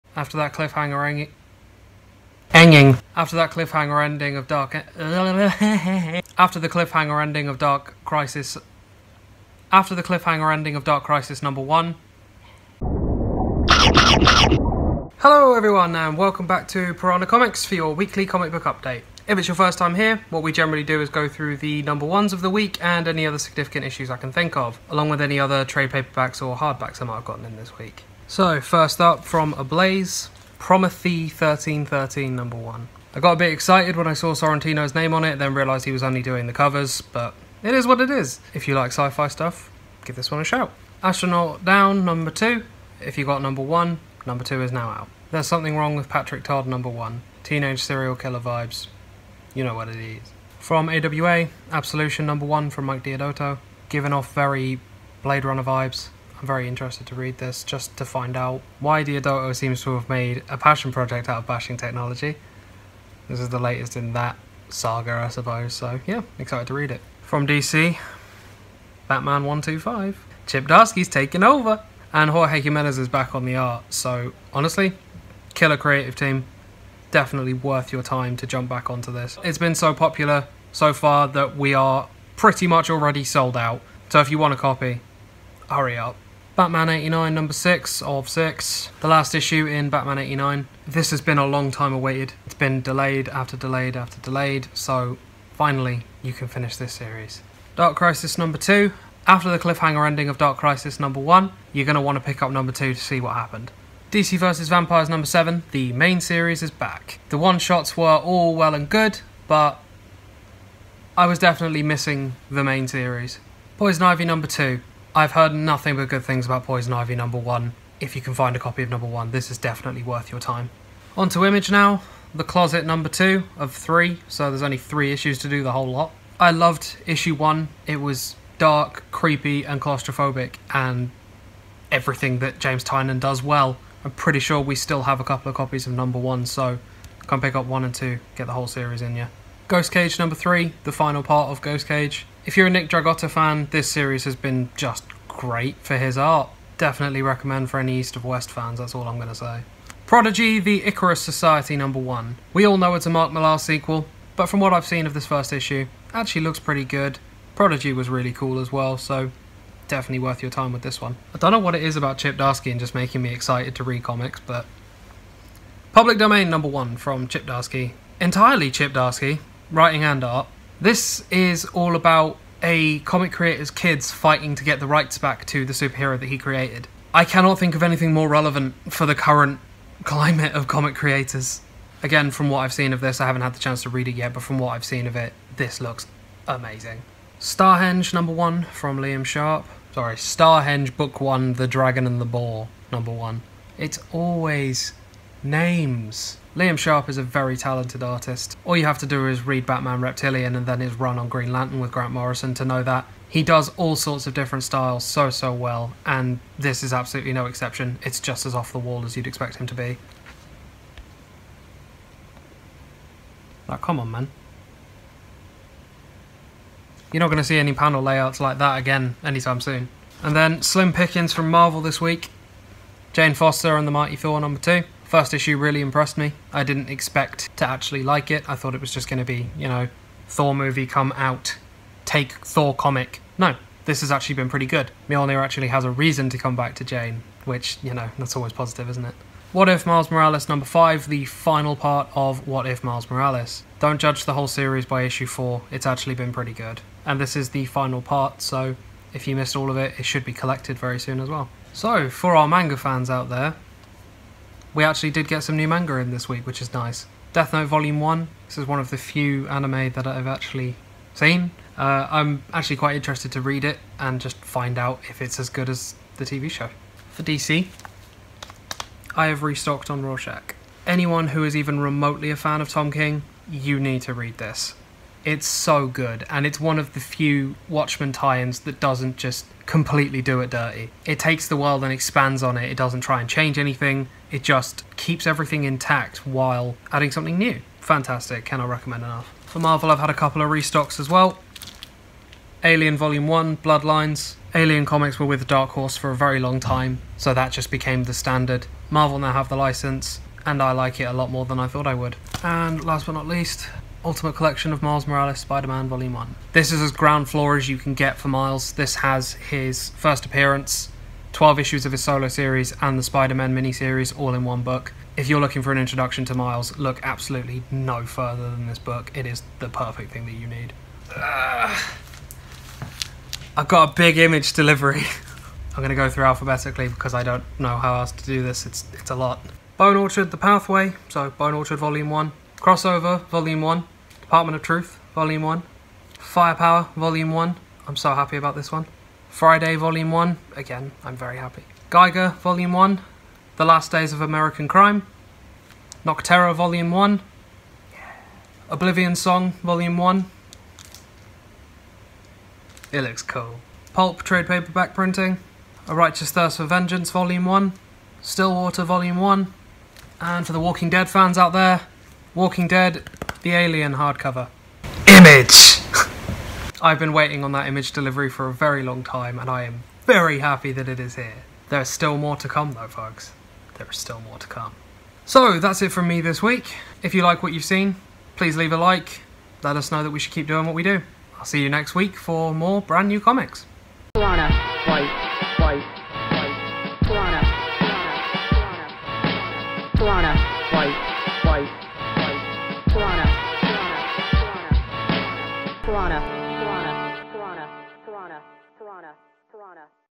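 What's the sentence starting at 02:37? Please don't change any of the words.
Prodigy was really cool as well, so definitely worth your time with this one.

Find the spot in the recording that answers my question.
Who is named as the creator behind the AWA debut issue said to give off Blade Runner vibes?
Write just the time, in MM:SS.
00:52.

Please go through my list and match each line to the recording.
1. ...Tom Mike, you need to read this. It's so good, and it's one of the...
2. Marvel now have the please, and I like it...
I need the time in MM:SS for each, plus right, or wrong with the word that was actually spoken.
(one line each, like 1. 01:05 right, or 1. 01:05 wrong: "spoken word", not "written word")
1. 04:32 wrong: "King", not "Mike"
2. 04:58 wrong: "license", not "please".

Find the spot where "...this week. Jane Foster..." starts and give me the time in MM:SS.
03:41.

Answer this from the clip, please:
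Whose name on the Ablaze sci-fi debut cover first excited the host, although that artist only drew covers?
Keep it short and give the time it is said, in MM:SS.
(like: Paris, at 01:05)
Sorrentino, at 00:34.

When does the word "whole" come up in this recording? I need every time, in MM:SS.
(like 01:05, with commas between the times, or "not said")
02:05, 02:18, 04:04.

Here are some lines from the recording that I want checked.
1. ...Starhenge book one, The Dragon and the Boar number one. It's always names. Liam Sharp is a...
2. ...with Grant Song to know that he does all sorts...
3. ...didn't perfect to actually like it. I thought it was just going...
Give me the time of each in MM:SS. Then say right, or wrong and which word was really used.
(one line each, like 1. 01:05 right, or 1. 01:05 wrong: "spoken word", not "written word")
1. 03:10 right
2. 03:21 wrong: "Morrison", not "Song"
3. 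03:46 wrong: "expect", not "perfect".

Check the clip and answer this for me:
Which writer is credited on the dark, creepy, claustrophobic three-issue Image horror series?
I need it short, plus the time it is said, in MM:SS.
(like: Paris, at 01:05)
James Tynion, at 02:12.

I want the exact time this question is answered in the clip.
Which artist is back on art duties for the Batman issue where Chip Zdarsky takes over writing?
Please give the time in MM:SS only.
01:12.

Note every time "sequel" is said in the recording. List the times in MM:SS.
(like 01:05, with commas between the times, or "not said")
02:33.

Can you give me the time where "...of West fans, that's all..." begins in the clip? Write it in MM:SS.
02:28.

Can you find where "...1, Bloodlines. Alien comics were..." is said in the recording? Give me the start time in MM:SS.
04:53.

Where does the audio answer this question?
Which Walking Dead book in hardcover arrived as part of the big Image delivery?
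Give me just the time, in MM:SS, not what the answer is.
06:03.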